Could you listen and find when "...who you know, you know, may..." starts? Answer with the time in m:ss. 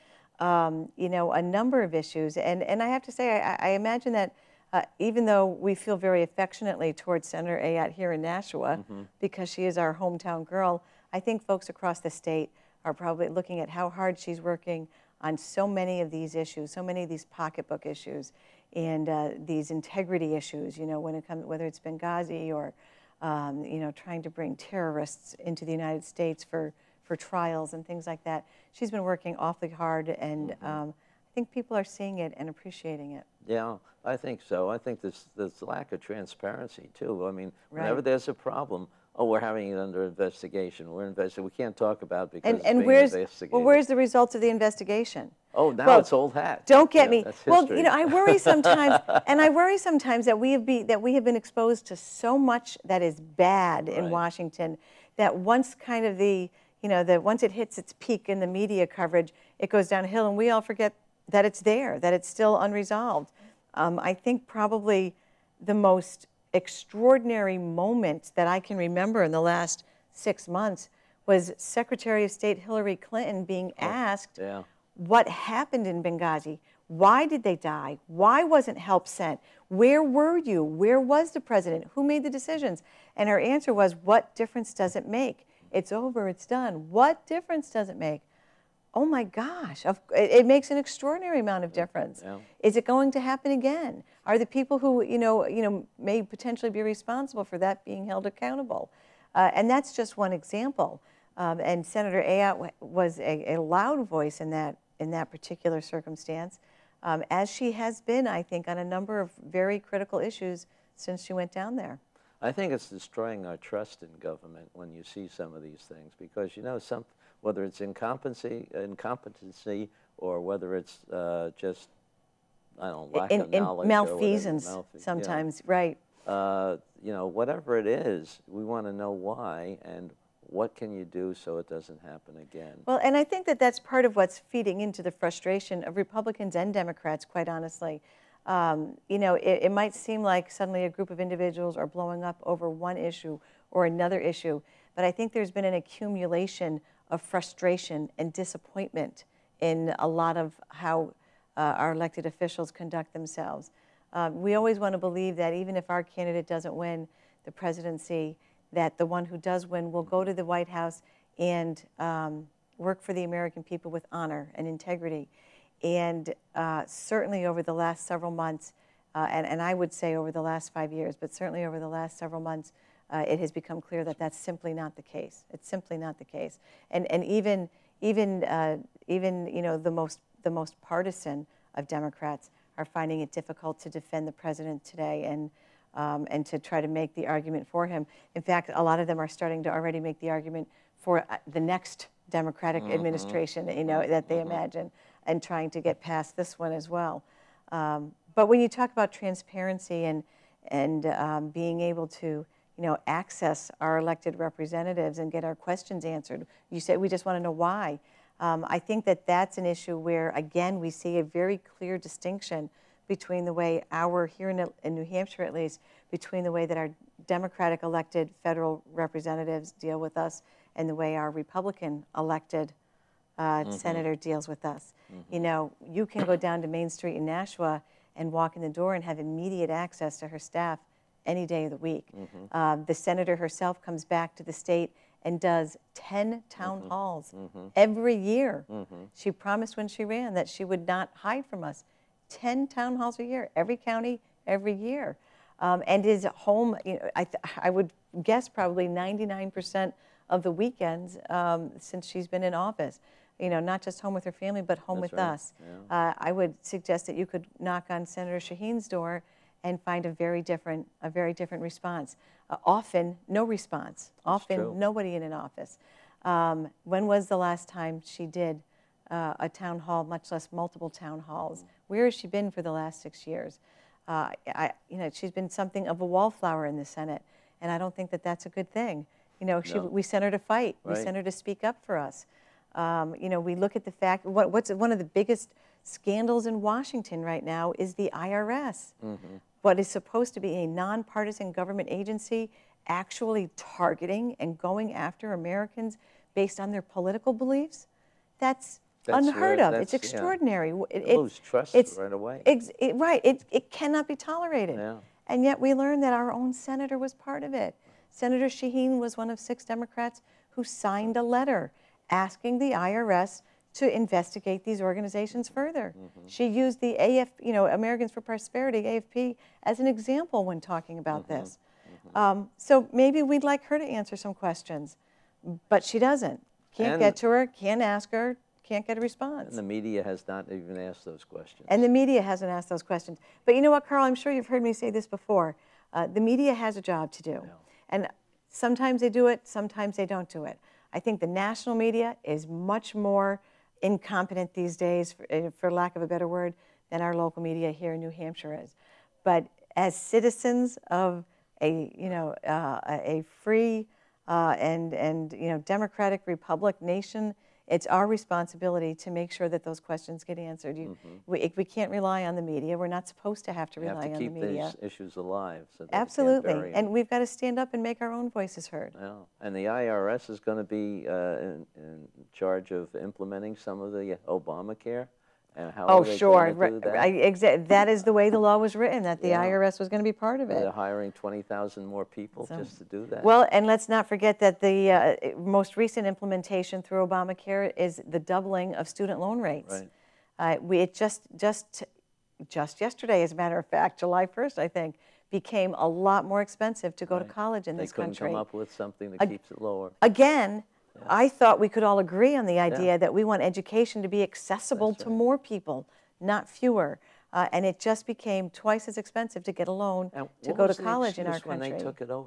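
1:34.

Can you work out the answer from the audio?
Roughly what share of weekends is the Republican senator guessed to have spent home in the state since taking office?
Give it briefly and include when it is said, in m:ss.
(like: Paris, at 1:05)
99%, at 4:08.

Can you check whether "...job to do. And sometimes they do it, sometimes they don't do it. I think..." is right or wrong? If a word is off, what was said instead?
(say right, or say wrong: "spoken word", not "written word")
right.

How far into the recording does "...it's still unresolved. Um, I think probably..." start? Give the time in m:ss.
1:02.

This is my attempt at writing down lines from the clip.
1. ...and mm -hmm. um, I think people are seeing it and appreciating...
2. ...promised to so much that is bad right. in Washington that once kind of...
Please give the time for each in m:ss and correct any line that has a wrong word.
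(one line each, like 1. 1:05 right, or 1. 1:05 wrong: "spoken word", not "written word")
1. 0:30 right
2. 0:51 wrong: "exposed", not "promised".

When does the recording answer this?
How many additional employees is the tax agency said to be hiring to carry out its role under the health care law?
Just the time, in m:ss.
6:21.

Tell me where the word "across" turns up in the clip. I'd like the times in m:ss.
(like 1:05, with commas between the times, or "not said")
0:11.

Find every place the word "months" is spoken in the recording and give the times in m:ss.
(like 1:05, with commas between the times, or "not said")
1:10, 2:48, 2:52.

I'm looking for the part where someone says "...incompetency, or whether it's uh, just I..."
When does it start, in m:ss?
1:58.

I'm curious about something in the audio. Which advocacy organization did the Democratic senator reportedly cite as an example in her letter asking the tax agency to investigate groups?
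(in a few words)
Americans for Prosperity.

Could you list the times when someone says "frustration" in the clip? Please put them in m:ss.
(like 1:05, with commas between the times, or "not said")
2:15, 2:27.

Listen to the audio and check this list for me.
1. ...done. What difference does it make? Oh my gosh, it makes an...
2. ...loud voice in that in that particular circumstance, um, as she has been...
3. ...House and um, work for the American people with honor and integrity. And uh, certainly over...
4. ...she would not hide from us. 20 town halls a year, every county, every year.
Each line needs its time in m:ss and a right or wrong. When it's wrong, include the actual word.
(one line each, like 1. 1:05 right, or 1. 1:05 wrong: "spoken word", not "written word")
1. 1:26 right
2. 1:43 right
3. 2:40 right
4. 4:00 wrong: "10", not "20".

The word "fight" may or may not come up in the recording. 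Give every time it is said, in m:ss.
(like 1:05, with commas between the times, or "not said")
4:40.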